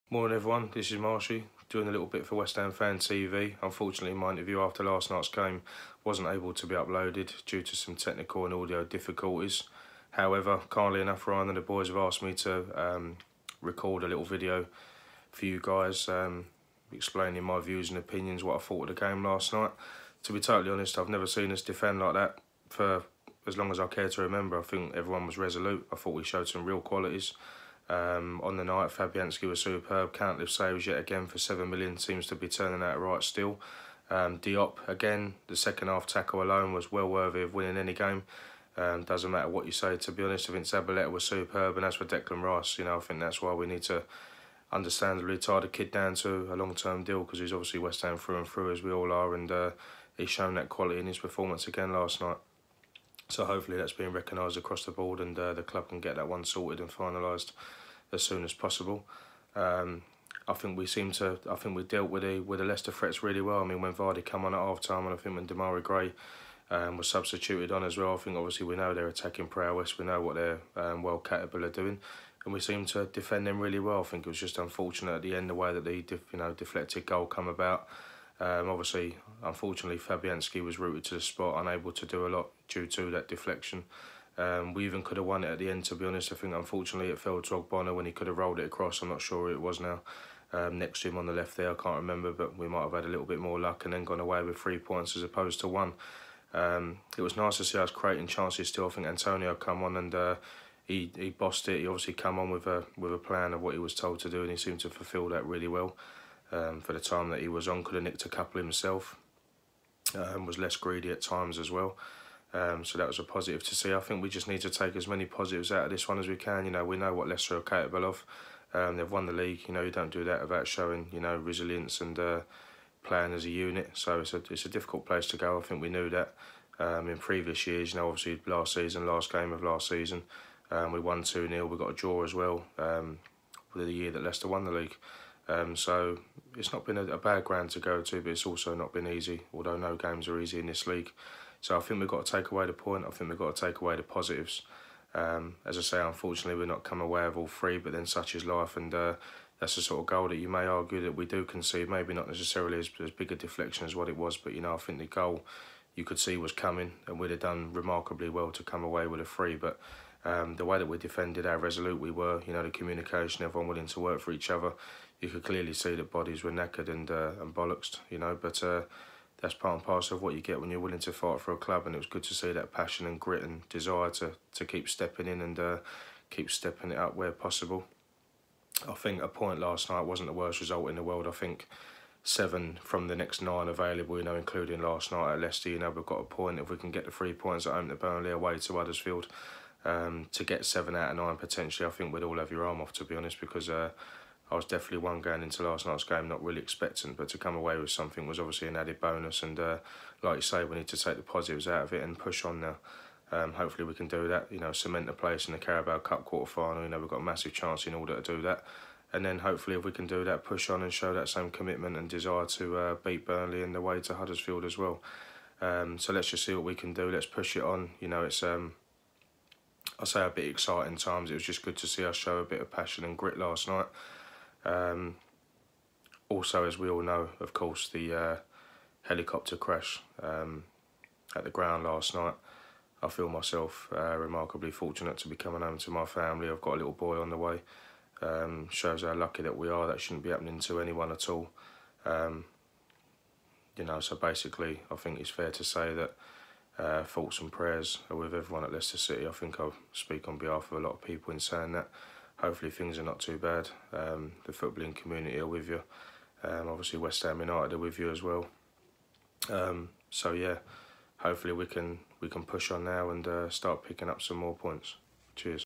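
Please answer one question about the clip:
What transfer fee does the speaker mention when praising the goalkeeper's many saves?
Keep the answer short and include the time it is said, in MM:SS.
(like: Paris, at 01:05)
7 million, at 00:31.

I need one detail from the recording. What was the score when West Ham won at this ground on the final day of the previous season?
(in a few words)
2-0.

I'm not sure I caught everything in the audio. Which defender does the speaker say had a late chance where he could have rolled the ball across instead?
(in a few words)
Ogbonna.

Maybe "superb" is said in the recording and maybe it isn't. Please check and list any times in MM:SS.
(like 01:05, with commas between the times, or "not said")
00:29, 00:41.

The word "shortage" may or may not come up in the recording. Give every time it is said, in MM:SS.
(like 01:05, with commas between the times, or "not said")
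not said.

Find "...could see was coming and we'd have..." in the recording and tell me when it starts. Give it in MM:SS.
02:36.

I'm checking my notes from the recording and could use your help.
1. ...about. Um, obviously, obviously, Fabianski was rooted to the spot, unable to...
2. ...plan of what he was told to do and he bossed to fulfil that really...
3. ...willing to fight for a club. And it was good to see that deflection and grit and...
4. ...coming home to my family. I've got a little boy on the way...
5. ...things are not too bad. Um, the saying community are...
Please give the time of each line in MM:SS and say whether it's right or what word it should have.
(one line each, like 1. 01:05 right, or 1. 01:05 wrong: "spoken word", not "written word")
1. 01:17 wrong: "unfortunately", not "obviously"
2. 01:43 wrong: "seemed", not "bossed"
3. 02:50 wrong: "passion", not "deflection"
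4. 03:55 right
5. 04:12 wrong: "footballing", not "saying".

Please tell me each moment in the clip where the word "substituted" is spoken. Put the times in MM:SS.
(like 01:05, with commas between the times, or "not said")
01:07.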